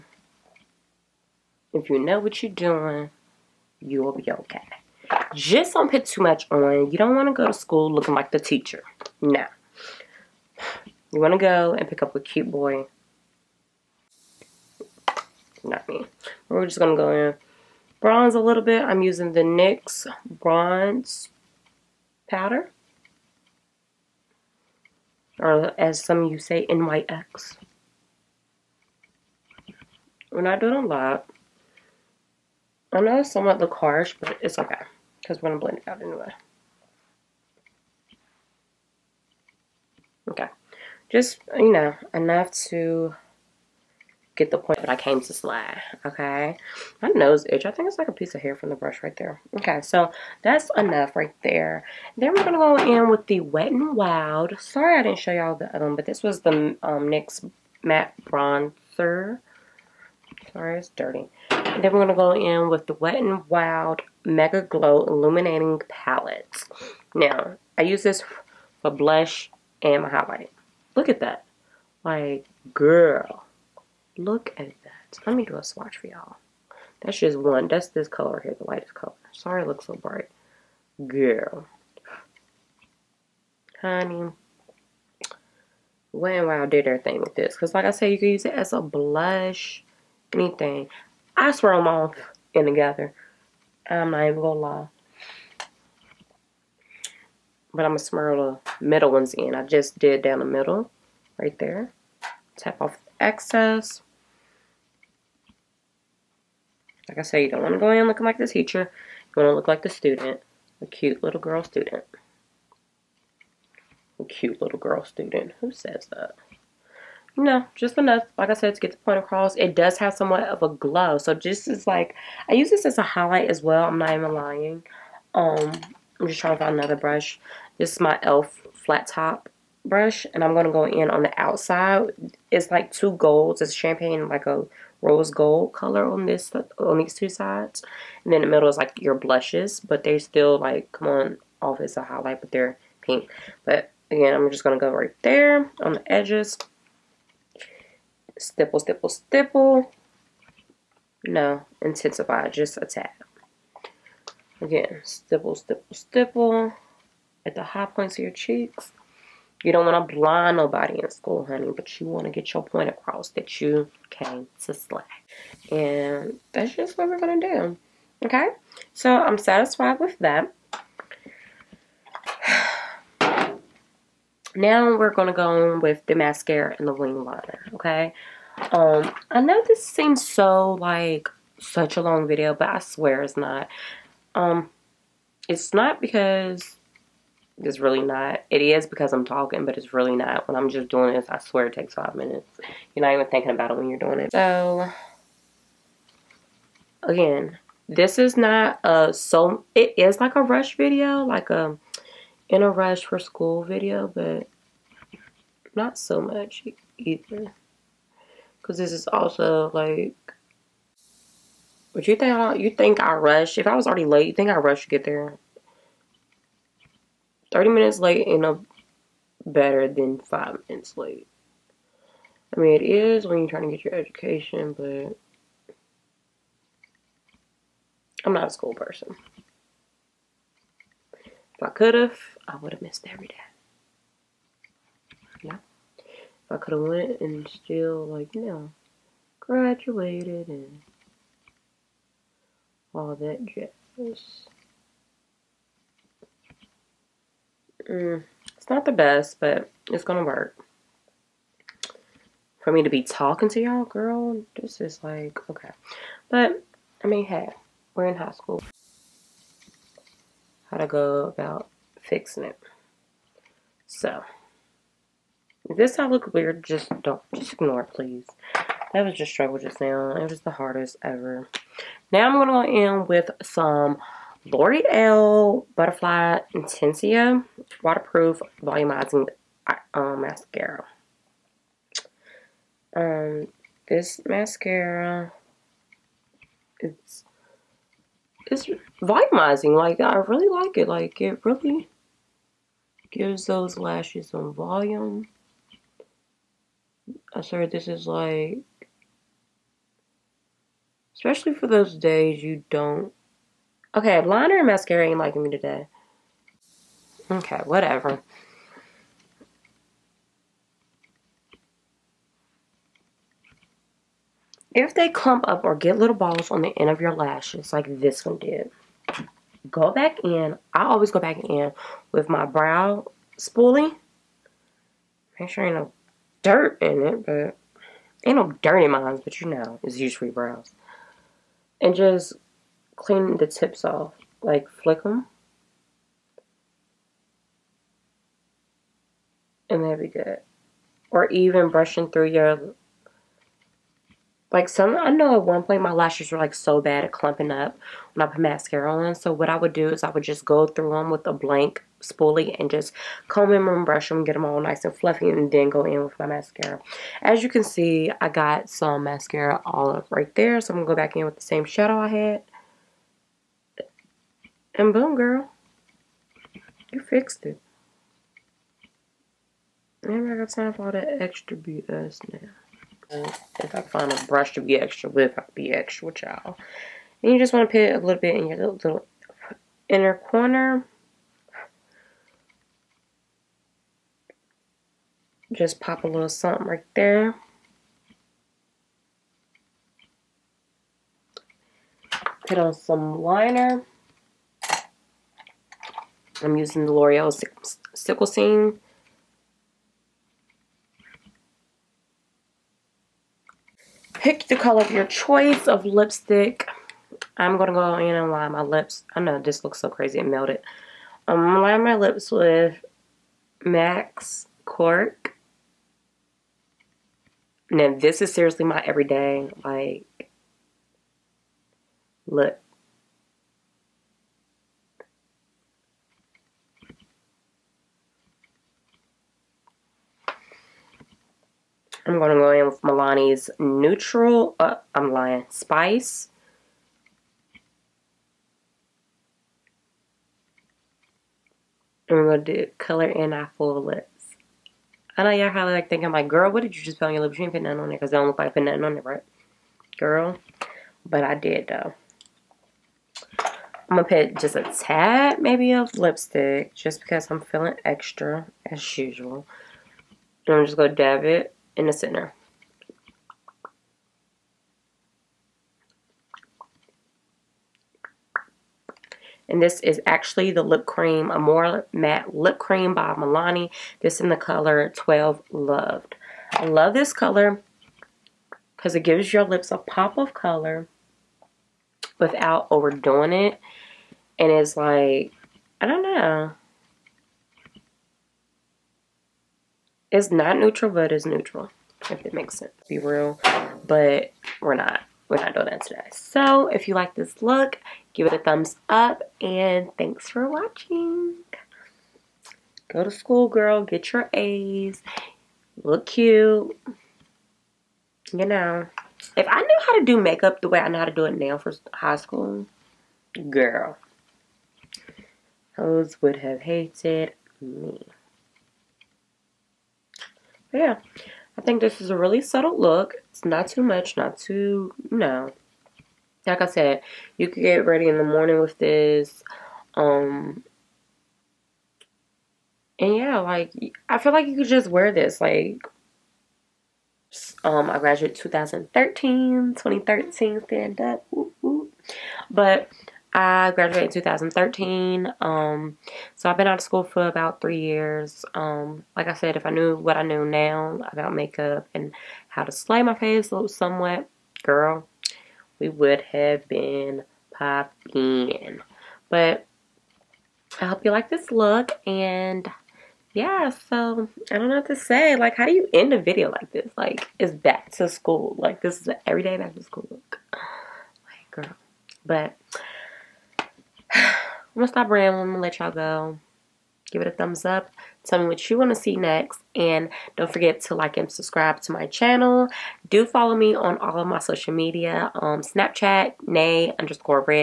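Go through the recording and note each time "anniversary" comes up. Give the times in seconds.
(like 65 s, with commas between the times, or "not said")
not said.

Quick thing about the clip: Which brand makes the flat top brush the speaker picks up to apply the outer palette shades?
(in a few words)
e.l.f.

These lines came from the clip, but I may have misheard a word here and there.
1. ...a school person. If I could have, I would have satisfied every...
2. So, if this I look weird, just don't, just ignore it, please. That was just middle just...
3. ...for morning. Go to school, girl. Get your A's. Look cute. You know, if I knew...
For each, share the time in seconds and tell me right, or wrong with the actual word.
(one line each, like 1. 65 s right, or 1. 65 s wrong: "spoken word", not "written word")
1. 228 s wrong: "missed", not "satisfied"
2. 263 s wrong: "struggle", not "middle"
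3. 500 s wrong: "watching", not "morning".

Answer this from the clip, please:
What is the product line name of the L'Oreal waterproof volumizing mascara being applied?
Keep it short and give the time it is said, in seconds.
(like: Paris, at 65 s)
Butterfly Intenza, at 275 s.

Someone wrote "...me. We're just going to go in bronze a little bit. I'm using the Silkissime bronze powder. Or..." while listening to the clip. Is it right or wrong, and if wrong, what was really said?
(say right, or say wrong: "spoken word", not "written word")
wrong: "NYX", not "Silkissime".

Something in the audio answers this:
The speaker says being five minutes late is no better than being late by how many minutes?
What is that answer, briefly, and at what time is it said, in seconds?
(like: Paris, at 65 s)
30, at 217 s.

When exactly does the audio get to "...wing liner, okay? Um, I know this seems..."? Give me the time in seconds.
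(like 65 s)
176 s.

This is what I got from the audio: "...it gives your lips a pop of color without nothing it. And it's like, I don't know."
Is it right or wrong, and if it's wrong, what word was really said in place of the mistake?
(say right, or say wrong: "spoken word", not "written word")
wrong: "overdoing", not "nothing".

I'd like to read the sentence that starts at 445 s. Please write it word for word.
I know y'all probably like thinking, like, girl, what did you just put on your lips?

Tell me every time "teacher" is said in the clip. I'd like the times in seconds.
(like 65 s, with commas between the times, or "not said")
8 s, 108 s.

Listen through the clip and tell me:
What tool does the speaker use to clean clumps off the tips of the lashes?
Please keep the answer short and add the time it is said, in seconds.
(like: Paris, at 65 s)
brow spoolie, at 322 s.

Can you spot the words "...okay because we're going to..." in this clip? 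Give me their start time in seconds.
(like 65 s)
34 s.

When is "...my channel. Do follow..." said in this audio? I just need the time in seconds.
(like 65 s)
581 s.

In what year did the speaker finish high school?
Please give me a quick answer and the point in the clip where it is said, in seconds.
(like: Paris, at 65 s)
2013, at 543 s.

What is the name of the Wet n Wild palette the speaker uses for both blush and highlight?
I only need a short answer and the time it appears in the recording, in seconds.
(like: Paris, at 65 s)
Mega Glo Illuminating Palette, at 64 s.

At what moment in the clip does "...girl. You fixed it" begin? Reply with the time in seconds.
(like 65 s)
365 s.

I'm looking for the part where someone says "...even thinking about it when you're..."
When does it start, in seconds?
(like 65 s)
193 s.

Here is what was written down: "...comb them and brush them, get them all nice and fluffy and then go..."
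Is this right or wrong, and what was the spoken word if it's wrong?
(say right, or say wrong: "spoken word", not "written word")
right.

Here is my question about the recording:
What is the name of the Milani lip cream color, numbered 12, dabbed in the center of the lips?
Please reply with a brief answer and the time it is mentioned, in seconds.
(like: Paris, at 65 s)
Loved, at 475 s.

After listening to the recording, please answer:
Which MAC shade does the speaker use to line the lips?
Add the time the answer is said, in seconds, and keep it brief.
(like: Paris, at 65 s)
Cork, at 414 s.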